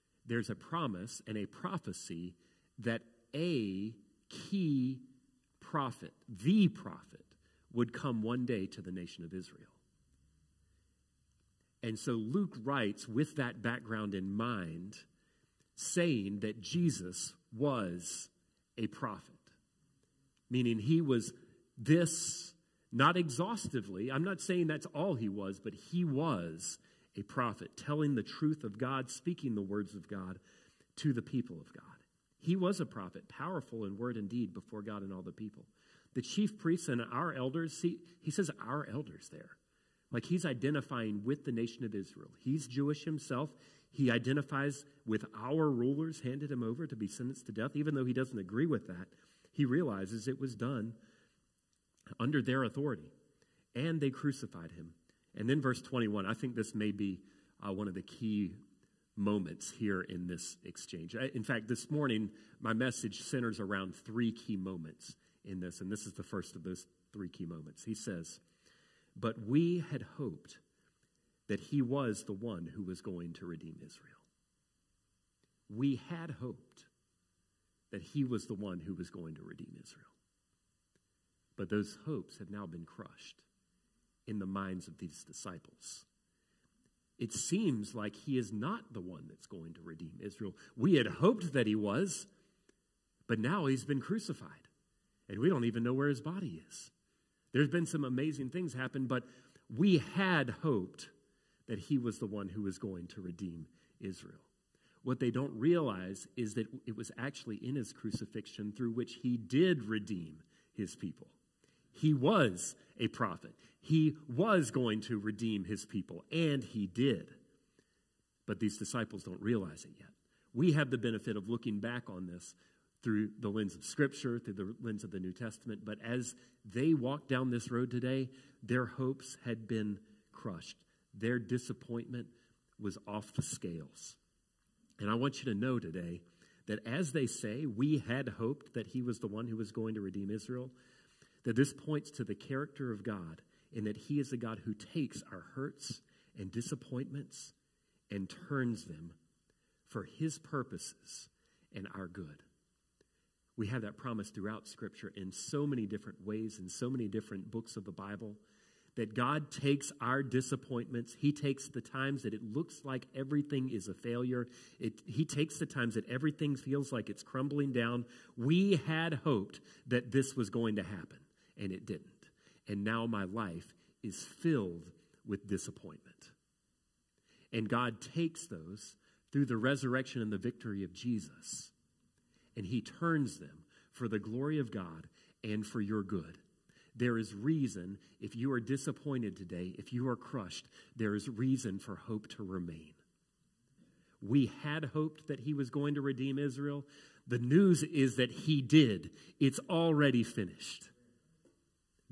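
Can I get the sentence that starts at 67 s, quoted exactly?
He says, But we had hoped that he was the one who was going to redeem Israel.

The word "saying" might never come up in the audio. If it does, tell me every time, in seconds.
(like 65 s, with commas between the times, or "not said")
15 s, 24 s.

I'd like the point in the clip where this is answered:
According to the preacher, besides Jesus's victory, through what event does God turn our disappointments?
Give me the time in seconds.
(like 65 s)
179 s.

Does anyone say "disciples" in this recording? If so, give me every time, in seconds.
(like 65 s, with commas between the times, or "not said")
85 s, 118 s.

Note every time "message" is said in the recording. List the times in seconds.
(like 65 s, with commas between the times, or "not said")
62 s.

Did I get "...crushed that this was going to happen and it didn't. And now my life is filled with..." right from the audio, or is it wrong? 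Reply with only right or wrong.
wrong.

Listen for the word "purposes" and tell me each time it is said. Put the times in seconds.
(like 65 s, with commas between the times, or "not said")
150 s.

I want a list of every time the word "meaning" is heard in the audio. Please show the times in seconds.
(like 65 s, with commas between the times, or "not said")
20 s.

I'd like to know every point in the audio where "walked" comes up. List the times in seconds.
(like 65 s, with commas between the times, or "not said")
126 s.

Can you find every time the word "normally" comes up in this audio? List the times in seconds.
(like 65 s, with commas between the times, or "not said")
not said.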